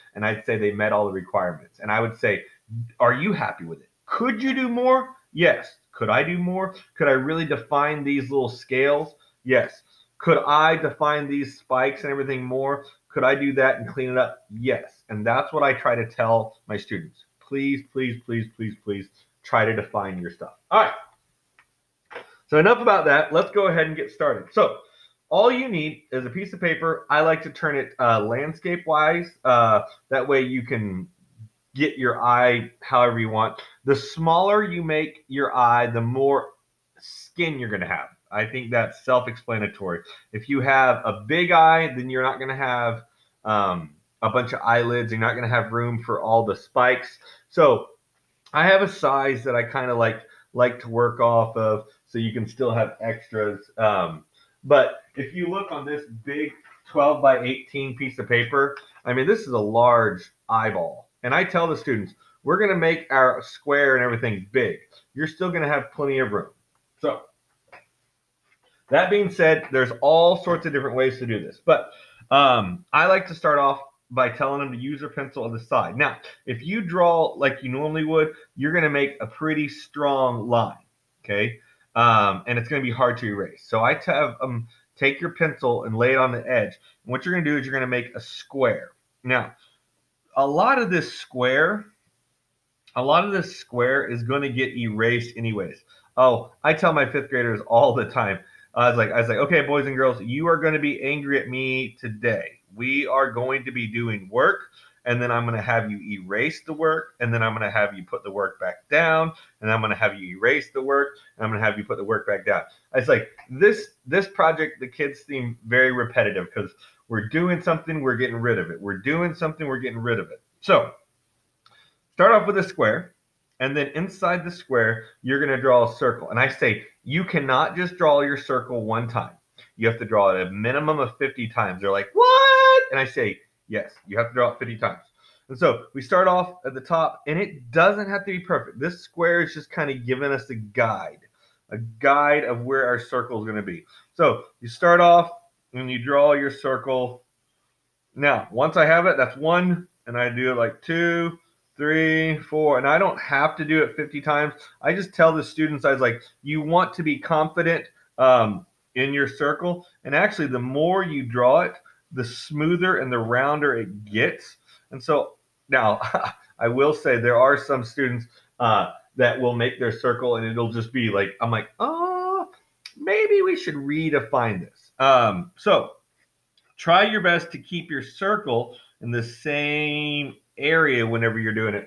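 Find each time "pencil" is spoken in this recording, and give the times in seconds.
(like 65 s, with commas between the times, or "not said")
75 s, 85 s.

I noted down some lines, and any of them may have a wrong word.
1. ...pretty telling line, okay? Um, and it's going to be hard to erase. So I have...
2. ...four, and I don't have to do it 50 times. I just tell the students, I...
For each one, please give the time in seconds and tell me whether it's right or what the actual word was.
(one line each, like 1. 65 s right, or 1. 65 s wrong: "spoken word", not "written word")
1. 79 s wrong: "strong", not "telling"
2. 152 s right.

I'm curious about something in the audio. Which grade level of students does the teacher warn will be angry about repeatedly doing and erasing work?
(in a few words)
fifth graders.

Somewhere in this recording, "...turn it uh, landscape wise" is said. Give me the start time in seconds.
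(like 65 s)
27 s.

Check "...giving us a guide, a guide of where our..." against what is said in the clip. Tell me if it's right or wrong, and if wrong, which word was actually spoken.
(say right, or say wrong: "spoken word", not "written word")
right.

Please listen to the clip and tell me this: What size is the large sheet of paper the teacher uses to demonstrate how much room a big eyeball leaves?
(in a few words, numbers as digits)
12 by 18.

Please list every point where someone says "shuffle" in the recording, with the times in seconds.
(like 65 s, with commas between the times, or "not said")
not said.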